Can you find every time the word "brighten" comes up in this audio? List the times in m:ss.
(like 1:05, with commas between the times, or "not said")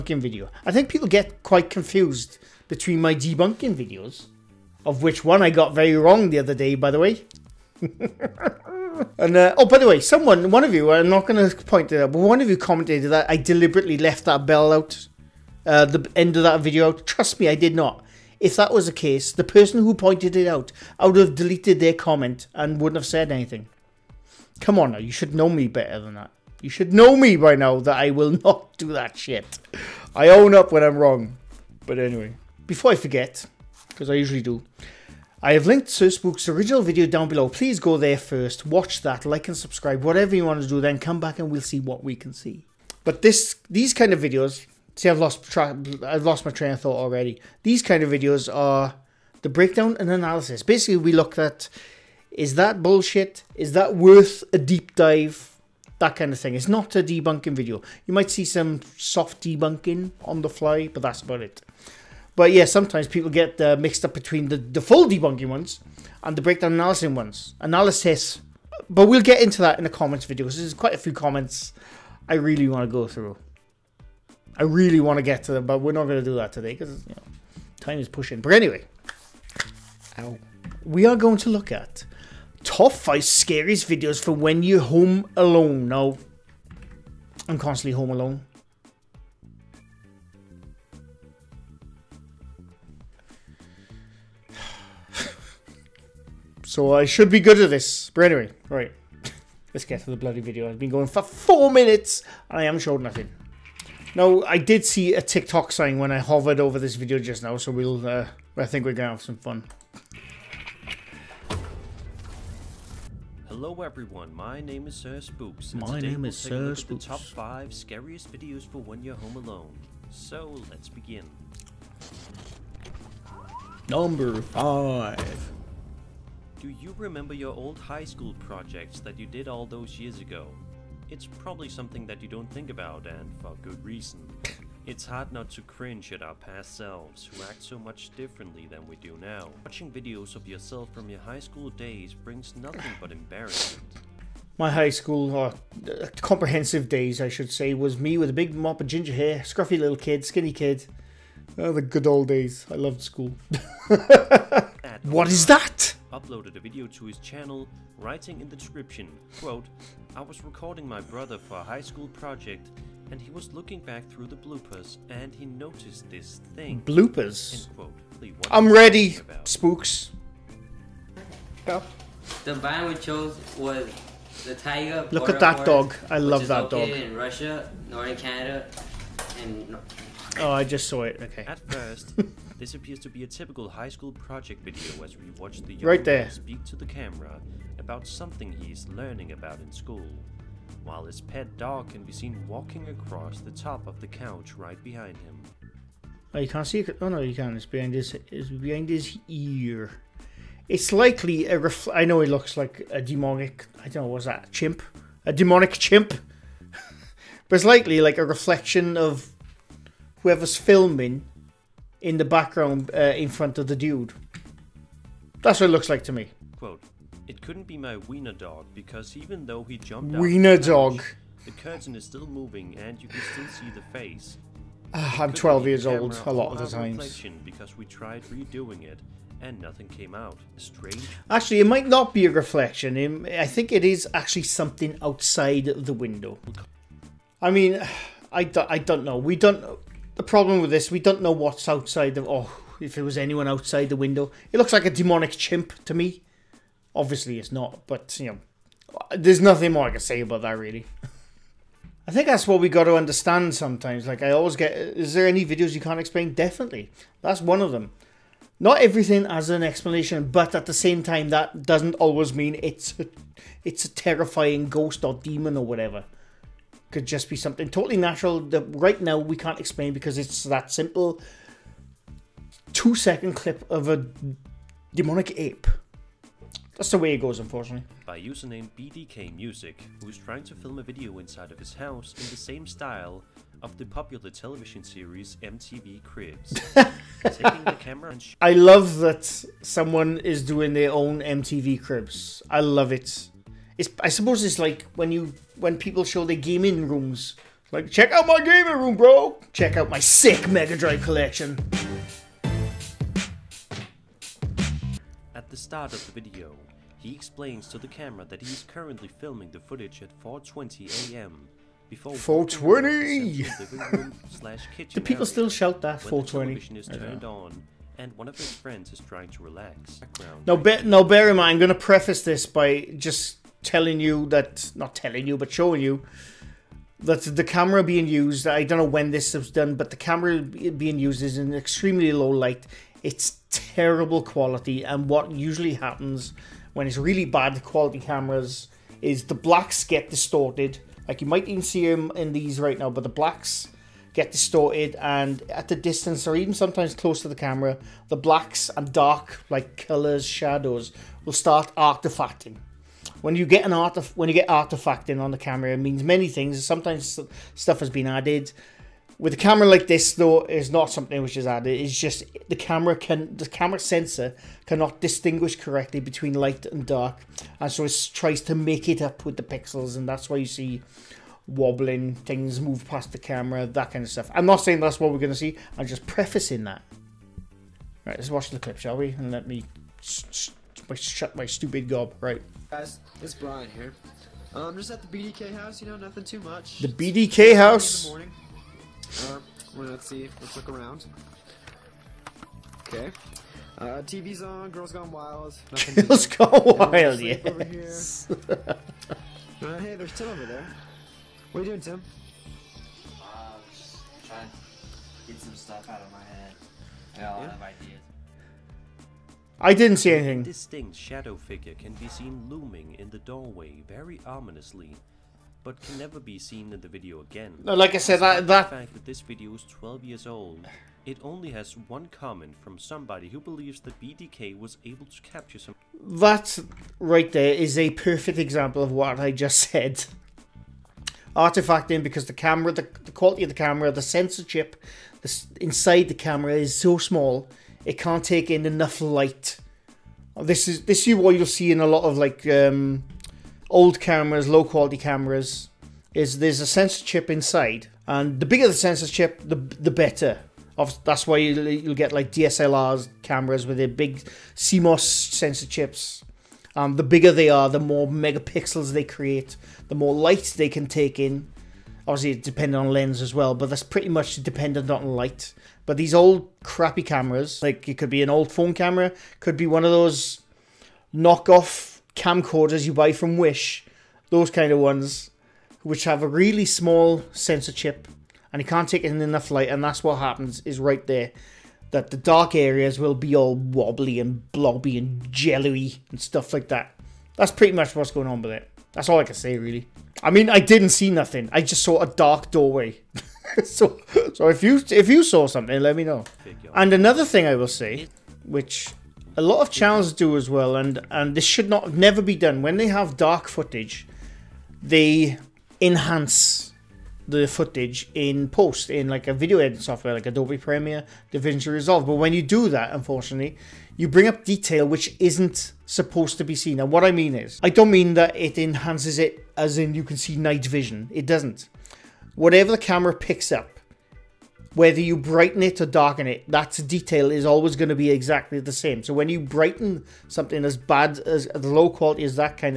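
8:45, 8:49.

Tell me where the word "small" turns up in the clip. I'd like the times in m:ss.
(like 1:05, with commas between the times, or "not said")
7:16, 7:56.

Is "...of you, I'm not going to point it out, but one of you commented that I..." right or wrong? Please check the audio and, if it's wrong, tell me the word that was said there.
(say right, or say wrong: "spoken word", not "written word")
right.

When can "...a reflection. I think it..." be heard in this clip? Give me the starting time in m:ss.
3:52.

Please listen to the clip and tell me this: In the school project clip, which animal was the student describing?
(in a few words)
The tiger.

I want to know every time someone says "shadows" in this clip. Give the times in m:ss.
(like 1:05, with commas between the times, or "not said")
5:50, 6:50.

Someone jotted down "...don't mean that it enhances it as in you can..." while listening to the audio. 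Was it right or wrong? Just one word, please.
right.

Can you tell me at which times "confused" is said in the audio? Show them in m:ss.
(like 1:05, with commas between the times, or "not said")
0:01.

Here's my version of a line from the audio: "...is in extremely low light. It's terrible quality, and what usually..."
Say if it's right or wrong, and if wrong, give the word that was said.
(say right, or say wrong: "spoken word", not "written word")
right.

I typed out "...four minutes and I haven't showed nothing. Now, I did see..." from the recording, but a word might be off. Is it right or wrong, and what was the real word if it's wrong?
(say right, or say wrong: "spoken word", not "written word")
right.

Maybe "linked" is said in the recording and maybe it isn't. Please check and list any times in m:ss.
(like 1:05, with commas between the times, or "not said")
0:35.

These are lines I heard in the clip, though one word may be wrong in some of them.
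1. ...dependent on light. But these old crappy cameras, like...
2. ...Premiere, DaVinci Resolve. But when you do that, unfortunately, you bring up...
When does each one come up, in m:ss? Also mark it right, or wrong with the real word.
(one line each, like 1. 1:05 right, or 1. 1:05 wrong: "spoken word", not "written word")
1. 7:44 right
2. 8:30 right.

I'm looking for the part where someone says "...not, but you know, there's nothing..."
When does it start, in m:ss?
4:07.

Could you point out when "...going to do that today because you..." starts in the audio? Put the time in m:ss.
1:16.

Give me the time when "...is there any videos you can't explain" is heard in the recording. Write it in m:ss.
4:14.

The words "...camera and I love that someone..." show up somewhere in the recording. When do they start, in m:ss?
4:47.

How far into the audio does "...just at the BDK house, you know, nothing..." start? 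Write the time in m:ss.
6:24.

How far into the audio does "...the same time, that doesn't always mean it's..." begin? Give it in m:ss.
4:20.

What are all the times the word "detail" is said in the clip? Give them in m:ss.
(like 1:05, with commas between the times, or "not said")
8:34, 8:46.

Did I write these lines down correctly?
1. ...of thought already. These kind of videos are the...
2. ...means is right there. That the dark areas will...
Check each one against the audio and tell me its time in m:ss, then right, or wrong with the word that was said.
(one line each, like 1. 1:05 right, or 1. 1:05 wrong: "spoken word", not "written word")
1. 0:46 right
2. 8:00 wrong: "happens", not "means".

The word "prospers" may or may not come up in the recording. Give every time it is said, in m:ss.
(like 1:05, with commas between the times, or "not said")
not said.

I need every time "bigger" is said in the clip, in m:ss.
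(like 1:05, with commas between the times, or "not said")
7:28, 7:37.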